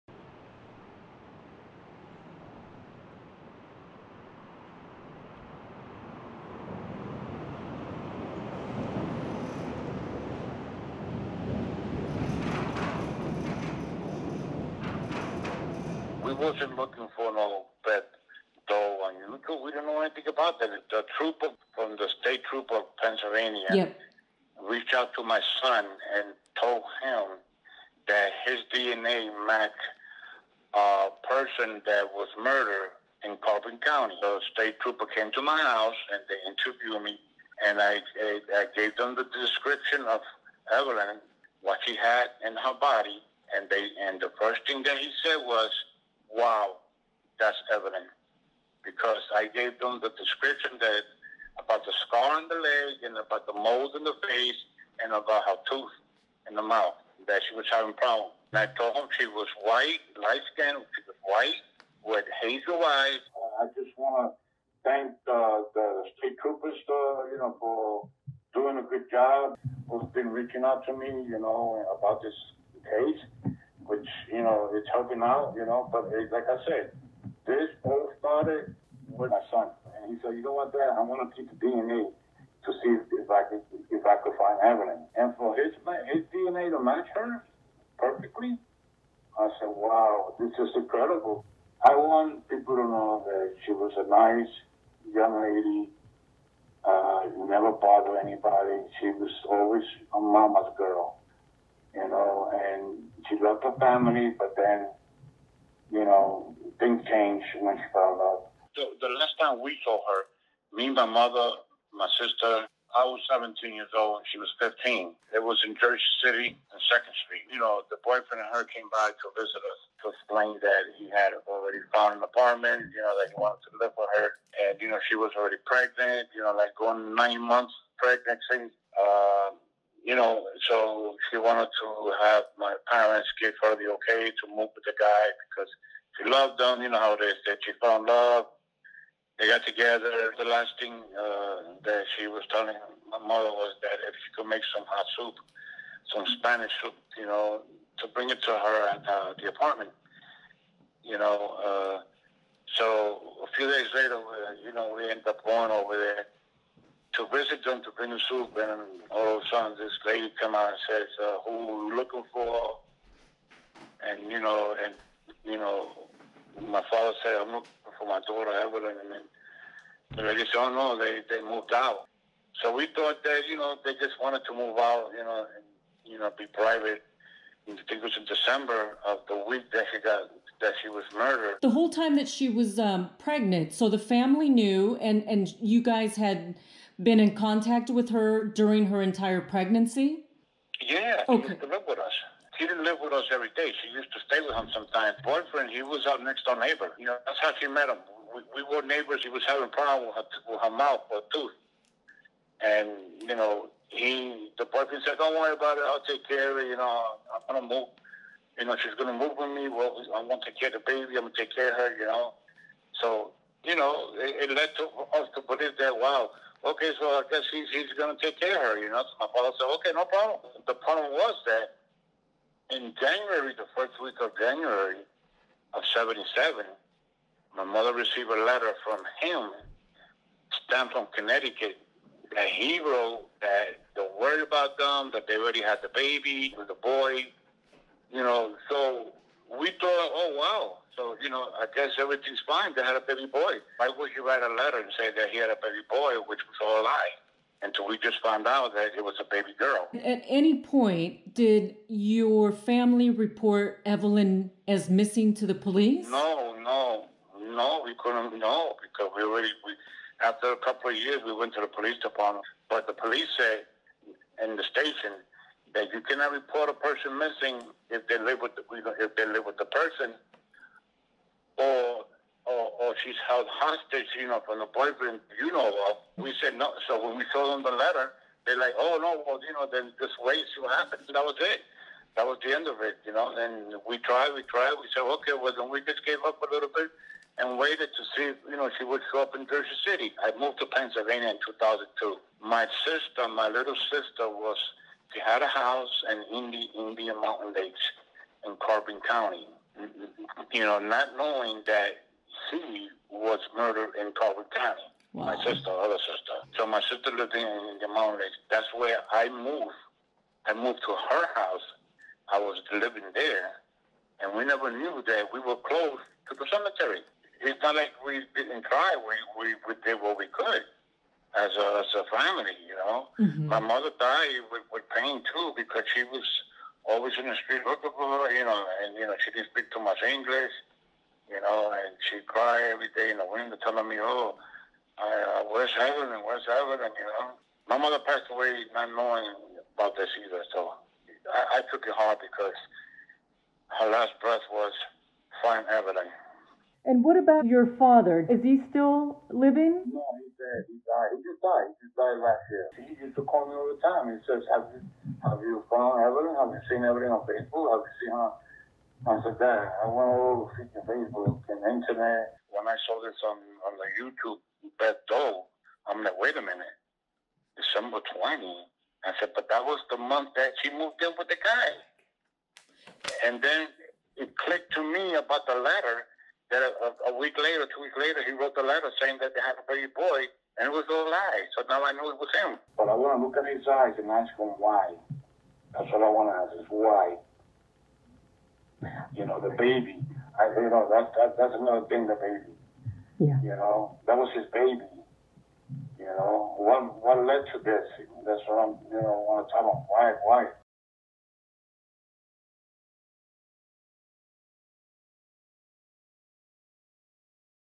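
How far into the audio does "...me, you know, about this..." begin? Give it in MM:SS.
01:10.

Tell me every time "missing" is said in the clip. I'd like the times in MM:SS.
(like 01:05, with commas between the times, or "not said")
04:14, 04:27.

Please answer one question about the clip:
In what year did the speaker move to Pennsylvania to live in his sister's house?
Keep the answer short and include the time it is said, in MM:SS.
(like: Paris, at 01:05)
2002, at 04:51.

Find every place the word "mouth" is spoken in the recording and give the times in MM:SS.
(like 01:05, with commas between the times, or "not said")
00:56, 03:20.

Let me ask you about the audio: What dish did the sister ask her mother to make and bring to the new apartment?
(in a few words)
Spanish soup.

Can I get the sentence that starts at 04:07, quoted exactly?
Until we just found out that it was a baby girl.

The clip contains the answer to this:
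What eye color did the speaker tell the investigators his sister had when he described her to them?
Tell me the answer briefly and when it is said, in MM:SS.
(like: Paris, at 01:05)
Hazel, at 01:02.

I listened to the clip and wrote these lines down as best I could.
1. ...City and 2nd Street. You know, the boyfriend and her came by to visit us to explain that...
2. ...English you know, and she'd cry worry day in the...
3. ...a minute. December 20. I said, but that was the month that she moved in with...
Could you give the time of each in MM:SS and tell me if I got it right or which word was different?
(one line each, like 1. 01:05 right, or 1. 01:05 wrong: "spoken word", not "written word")
1. 01:56 right
2. 05:30 wrong: "every", not "worry"
3. 06:06 right.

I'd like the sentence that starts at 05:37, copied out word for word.
My mother passed away not knowing about this either, so I, I took it hard because her last breath was, find Evelyn.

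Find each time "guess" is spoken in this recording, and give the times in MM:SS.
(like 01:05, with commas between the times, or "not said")
03:37, 04:01.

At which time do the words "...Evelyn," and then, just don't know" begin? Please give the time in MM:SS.
02:48.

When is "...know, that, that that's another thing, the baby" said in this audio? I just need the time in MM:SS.
06:30.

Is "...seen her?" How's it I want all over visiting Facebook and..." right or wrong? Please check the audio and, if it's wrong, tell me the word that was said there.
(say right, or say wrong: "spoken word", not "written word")
wrong: "freaking", not "visiting".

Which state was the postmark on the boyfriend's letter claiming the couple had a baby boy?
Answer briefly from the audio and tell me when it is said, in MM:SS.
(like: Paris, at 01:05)
Connecticut, at 03:51.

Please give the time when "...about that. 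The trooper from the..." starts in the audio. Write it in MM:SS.
00:20.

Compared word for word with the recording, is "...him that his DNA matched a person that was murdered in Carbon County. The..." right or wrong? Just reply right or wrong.
right.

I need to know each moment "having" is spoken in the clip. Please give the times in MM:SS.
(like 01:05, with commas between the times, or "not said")
00:57, 03:19.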